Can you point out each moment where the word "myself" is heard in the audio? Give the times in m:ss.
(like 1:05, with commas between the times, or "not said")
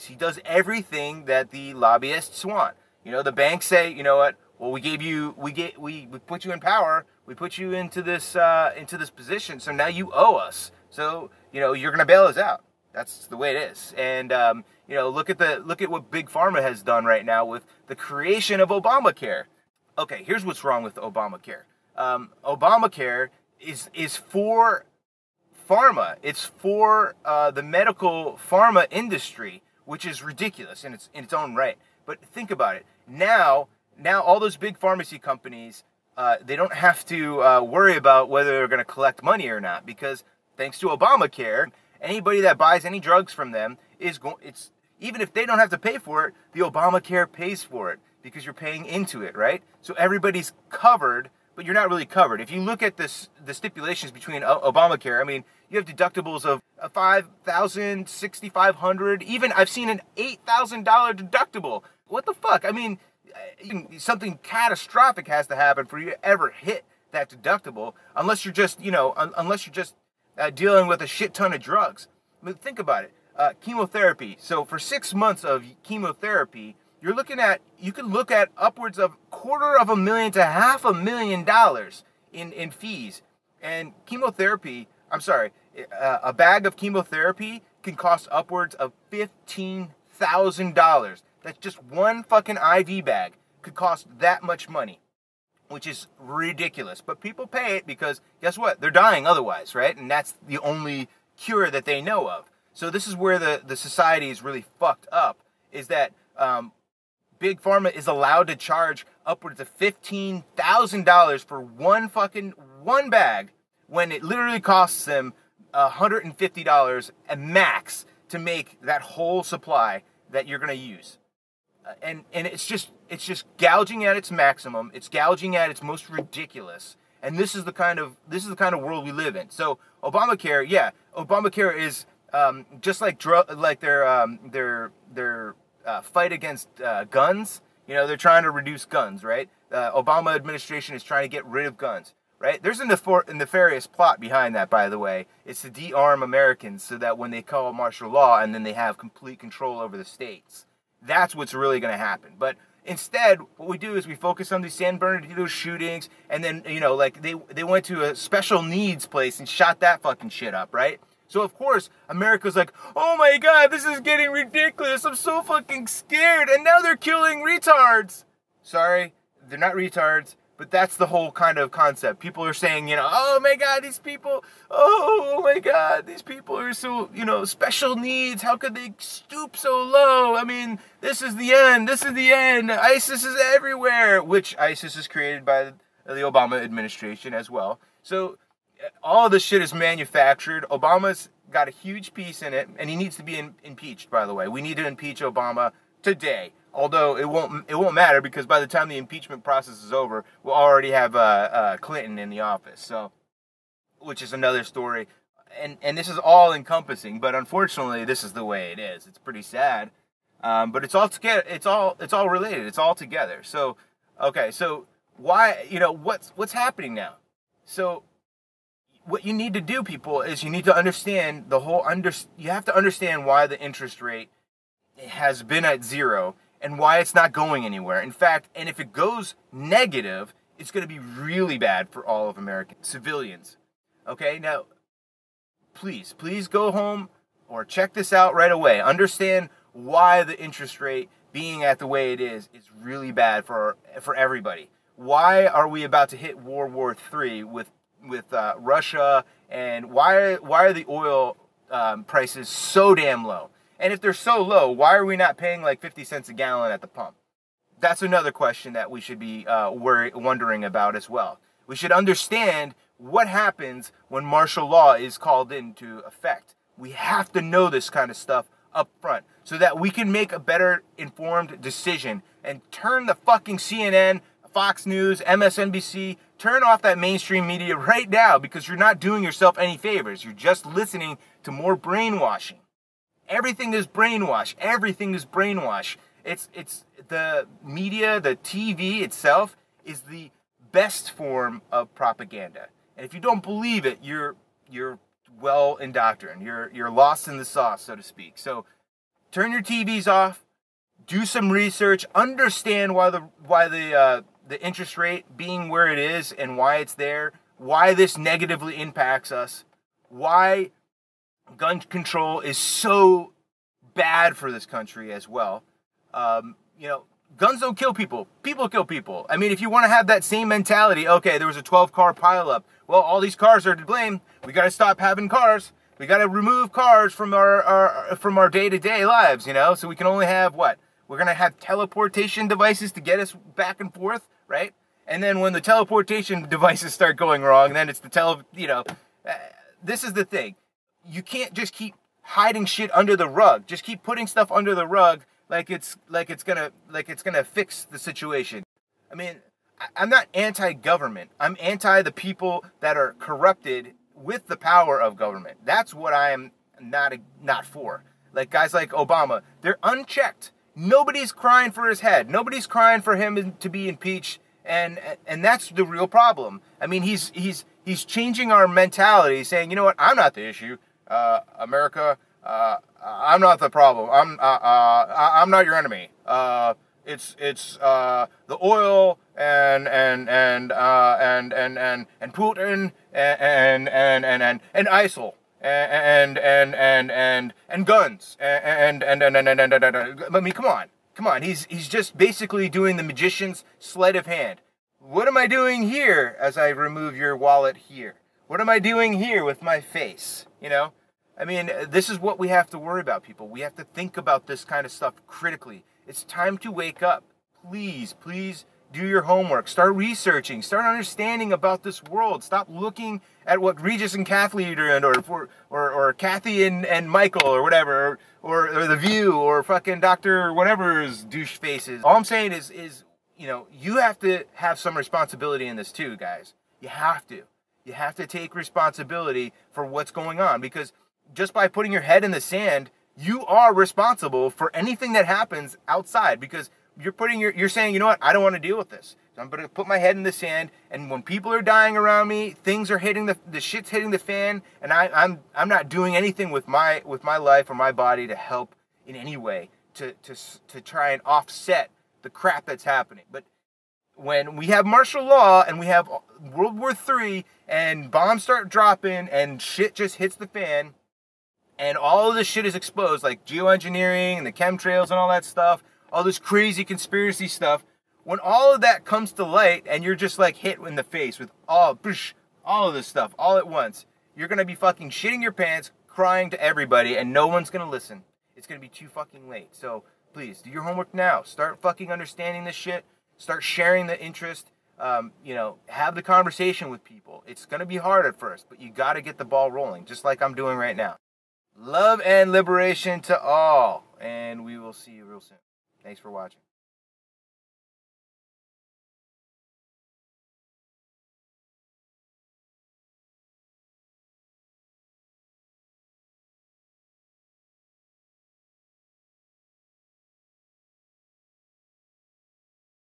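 not said.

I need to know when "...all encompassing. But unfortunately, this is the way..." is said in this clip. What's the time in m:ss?
3:26.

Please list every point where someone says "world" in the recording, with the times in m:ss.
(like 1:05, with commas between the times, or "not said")
2:08, 4:06, 6:52, 7:36.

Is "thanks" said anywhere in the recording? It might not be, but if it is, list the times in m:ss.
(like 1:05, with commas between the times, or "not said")
0:40, 8:16.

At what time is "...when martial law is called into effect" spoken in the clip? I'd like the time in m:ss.
4:24.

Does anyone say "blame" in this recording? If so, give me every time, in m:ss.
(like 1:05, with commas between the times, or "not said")
5:23.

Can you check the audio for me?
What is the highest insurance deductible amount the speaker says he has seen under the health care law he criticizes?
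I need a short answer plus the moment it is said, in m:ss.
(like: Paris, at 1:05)
$8,000, at 1:00.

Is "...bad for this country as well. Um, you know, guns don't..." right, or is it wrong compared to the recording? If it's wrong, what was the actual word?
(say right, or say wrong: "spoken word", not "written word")
right.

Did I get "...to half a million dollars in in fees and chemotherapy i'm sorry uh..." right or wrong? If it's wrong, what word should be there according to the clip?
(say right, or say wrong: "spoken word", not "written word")
right.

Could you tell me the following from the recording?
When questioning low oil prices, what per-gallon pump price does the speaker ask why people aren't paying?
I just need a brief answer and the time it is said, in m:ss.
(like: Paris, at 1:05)
50 cents, at 4:15.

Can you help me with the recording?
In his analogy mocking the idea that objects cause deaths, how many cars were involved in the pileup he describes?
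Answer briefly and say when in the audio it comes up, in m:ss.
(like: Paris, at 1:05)
12, at 5:21.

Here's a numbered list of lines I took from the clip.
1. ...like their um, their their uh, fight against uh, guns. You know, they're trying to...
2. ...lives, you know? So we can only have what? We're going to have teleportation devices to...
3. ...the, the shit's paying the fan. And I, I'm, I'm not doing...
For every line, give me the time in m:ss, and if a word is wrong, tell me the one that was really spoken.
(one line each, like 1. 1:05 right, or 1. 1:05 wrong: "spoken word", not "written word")
1. 2:13 right
2. 5:29 right
3. 7:23 wrong: "hitting", not "paying".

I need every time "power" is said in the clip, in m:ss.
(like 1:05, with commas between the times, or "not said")
0:06, 5:54.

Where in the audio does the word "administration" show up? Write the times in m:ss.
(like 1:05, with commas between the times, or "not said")
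2:20, 3:06.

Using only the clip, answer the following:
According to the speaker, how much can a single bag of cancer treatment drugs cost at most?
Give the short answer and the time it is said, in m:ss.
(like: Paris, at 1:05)
$15,000, at 1:29.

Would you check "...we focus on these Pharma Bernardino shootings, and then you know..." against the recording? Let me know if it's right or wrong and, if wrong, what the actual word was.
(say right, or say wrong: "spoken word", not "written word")
wrong: "San", not "Pharma".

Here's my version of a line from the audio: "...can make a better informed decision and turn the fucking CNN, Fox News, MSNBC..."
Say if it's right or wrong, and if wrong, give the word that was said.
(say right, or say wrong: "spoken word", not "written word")
right.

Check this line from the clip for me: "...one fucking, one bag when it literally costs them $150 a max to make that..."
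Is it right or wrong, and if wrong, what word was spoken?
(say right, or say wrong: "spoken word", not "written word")
right.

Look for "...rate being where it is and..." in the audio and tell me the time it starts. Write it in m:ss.
5:04.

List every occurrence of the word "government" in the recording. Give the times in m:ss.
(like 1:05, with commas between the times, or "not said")
5:50, 5:55.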